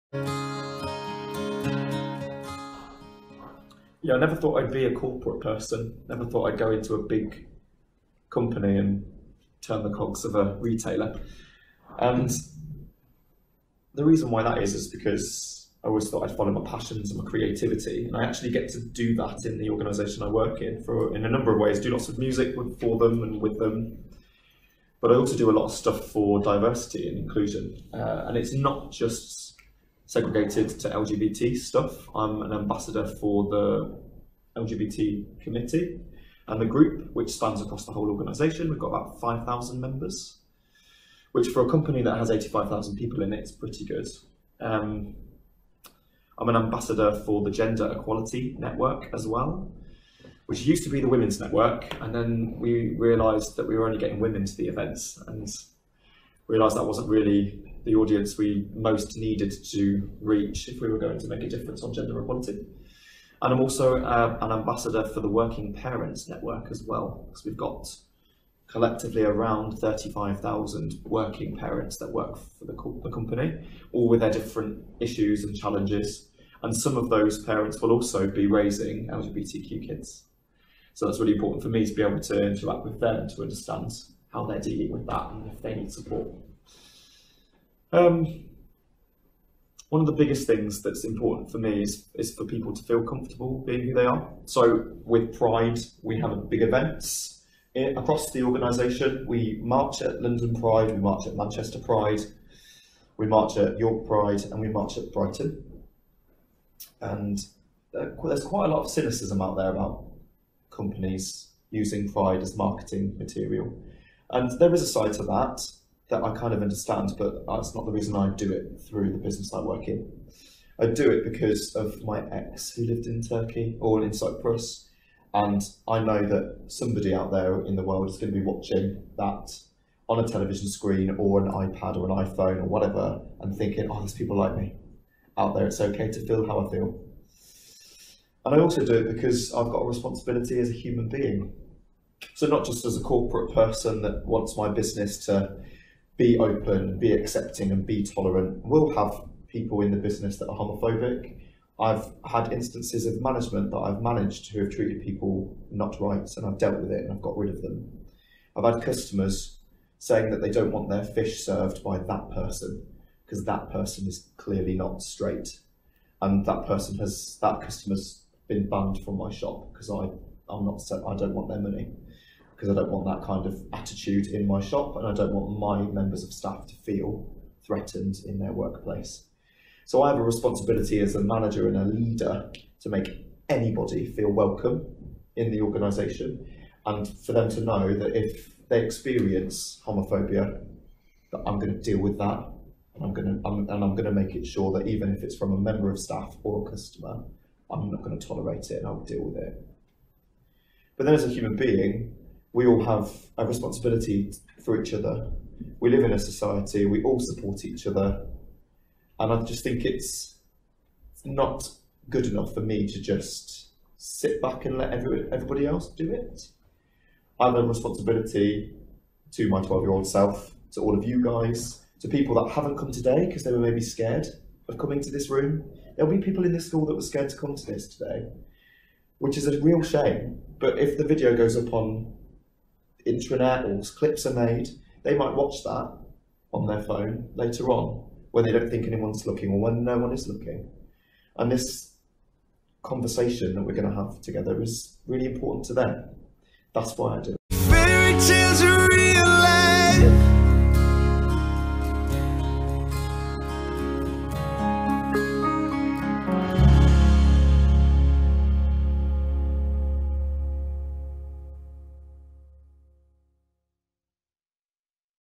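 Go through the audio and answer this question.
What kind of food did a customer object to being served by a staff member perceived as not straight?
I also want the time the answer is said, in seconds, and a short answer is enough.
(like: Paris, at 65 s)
Fish, at 161 s.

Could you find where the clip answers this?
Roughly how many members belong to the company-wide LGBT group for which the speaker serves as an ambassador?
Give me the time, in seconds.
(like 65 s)
39 s.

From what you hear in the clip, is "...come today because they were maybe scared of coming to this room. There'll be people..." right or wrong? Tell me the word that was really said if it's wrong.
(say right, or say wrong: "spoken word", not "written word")
right.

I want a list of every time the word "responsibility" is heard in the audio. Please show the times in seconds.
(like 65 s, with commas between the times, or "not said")
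139 s, 180 s, 203 s, 217 s.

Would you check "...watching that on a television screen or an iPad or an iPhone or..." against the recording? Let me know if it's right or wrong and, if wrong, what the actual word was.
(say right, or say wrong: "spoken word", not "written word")
right.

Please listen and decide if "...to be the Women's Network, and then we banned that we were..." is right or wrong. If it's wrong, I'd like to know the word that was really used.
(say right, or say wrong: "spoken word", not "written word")
wrong: "realised", not "banned".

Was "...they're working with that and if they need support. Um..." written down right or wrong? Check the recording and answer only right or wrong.
wrong.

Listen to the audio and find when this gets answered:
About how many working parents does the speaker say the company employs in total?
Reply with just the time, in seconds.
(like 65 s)
69 s.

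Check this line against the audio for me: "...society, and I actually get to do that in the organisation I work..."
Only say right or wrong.
wrong.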